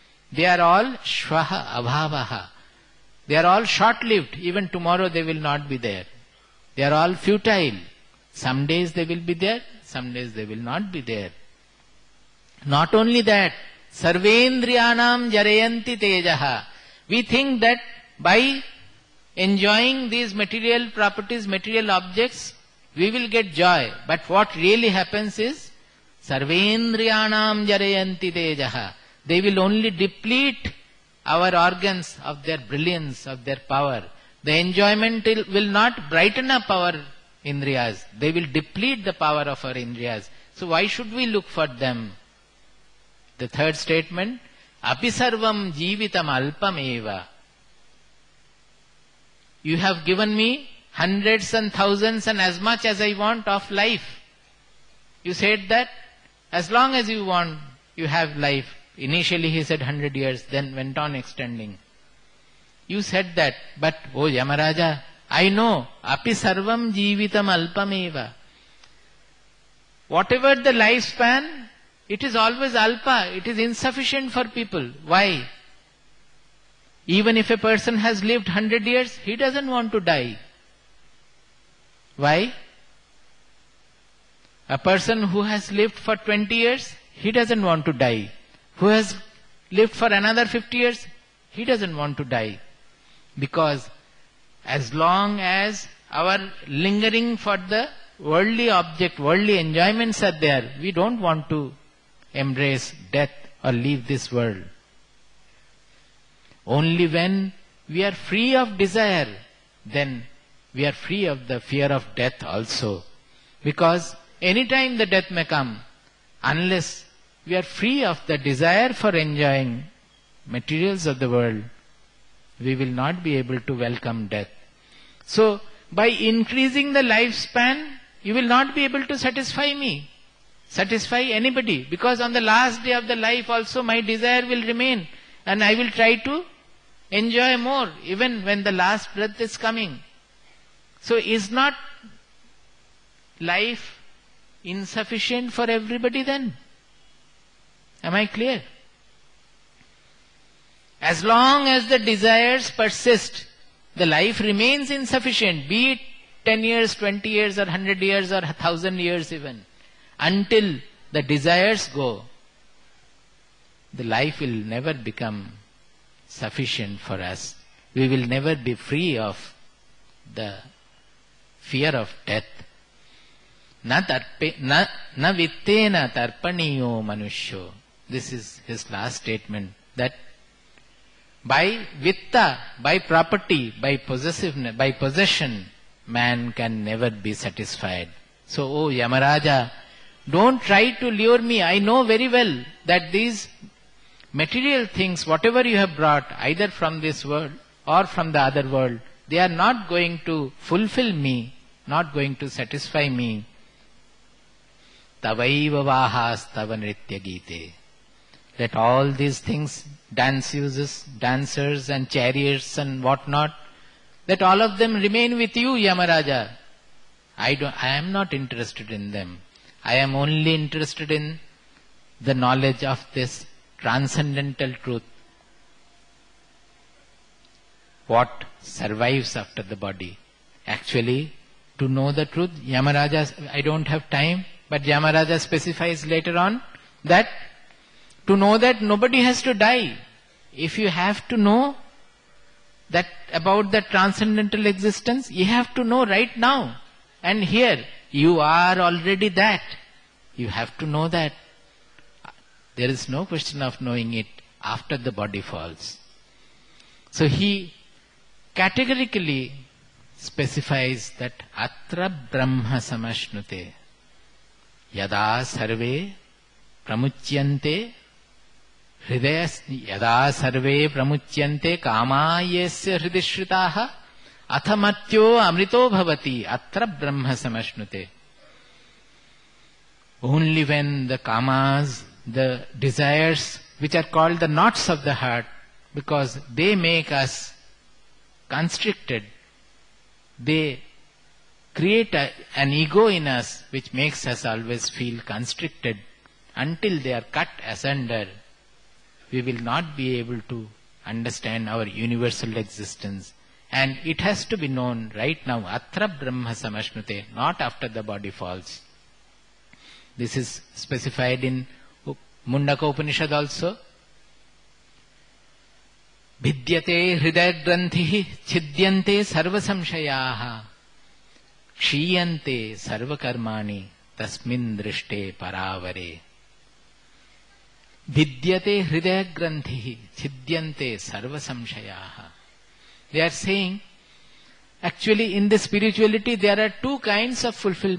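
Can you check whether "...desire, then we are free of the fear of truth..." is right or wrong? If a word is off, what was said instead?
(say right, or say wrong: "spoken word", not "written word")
wrong: "death", not "truth".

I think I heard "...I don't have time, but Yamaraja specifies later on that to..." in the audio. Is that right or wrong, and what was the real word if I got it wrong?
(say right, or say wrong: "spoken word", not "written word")
right.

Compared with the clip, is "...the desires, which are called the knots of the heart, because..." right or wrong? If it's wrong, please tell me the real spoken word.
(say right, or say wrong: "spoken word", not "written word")
right.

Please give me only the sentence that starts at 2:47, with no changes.
We will never be free of the fear of death.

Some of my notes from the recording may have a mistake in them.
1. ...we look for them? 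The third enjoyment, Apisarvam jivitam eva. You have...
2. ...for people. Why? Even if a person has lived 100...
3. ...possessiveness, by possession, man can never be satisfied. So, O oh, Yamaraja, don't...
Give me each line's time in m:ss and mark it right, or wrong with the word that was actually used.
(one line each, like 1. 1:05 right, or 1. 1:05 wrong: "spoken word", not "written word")
1. 0:41 wrong: "statement", not "enjoyment"
2. 1:14 right
3. 3:03 right.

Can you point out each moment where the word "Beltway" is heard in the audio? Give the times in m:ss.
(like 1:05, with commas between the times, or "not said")
not said.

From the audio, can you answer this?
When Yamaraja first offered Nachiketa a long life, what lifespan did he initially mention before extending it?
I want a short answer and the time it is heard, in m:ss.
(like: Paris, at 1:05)
100 years, at 0:59.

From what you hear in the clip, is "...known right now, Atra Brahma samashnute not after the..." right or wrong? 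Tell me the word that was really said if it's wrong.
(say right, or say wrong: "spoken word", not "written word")
right.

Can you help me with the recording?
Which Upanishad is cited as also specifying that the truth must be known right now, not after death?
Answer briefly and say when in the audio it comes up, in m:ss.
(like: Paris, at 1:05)
Mundaka Upanishad, at 5:12.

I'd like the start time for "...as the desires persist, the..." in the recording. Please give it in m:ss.
2:31.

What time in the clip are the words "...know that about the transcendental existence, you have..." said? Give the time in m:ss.
4:01.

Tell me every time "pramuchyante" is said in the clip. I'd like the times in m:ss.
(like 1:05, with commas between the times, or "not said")
4:26, 4:30.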